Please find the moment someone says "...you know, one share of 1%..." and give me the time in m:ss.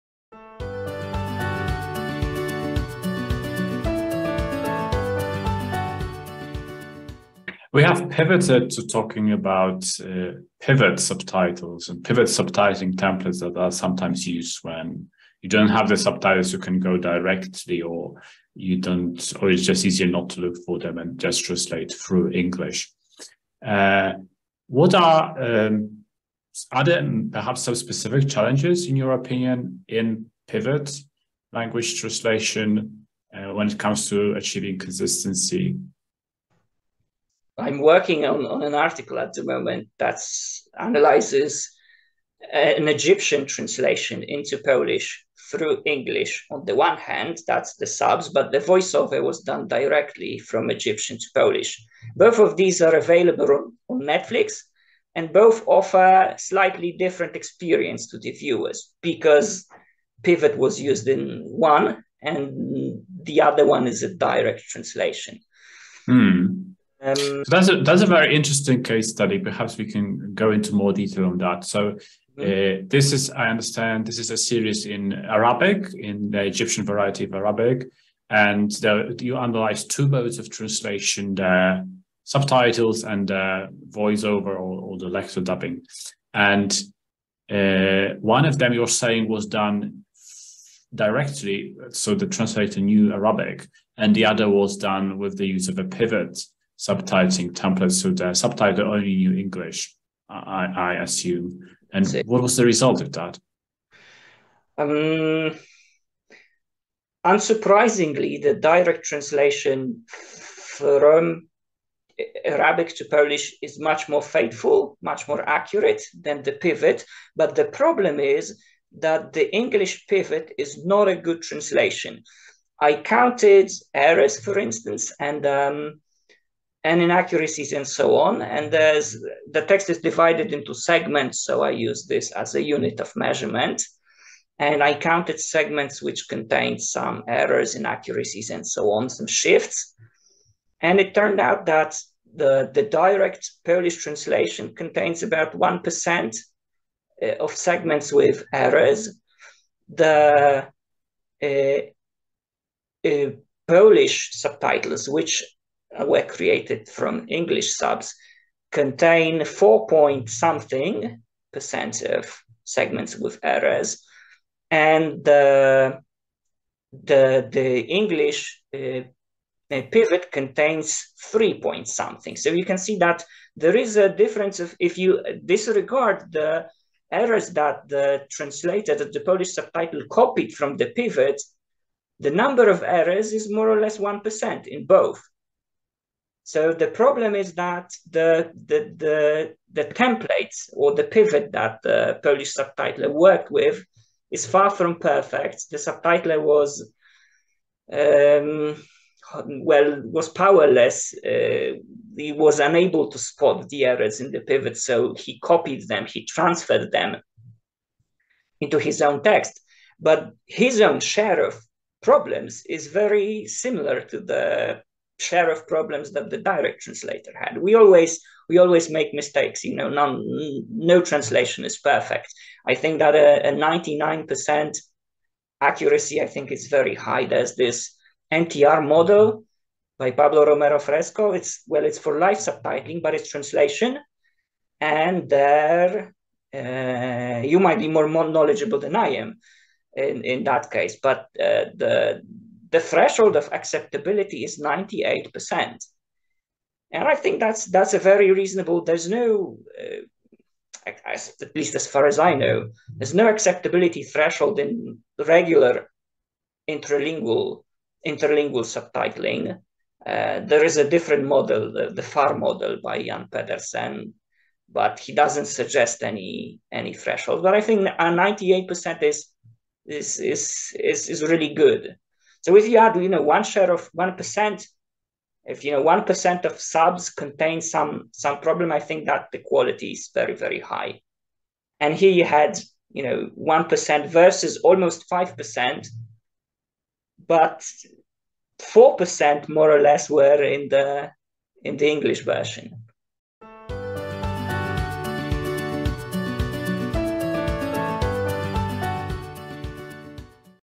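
4:33.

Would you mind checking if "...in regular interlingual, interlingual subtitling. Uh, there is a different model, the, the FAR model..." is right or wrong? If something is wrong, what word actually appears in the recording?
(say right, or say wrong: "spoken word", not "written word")
right.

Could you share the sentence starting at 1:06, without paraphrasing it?
Hmm so that's a that's a very interesting case study.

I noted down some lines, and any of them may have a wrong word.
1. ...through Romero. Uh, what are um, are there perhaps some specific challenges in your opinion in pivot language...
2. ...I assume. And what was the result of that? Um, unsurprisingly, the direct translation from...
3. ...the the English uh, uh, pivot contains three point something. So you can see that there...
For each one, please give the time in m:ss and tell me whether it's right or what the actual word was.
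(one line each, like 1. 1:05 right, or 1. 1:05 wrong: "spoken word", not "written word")
1. 0:21 wrong: "English", not "Romero"
2. 1:40 right
3. 2:47 right.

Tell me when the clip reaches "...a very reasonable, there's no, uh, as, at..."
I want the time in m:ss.
4:07.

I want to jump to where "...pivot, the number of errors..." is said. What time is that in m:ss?
3:00.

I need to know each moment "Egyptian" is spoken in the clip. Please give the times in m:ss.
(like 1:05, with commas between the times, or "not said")
0:42, 0:50, 1:16.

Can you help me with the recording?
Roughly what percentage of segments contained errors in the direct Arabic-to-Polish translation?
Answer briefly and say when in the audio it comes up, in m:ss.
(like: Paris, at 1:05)
1%, at 2:25.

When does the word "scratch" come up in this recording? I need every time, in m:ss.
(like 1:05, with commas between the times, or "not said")
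not said.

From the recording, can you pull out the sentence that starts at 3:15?
The subtitler was, um, well, was powerless.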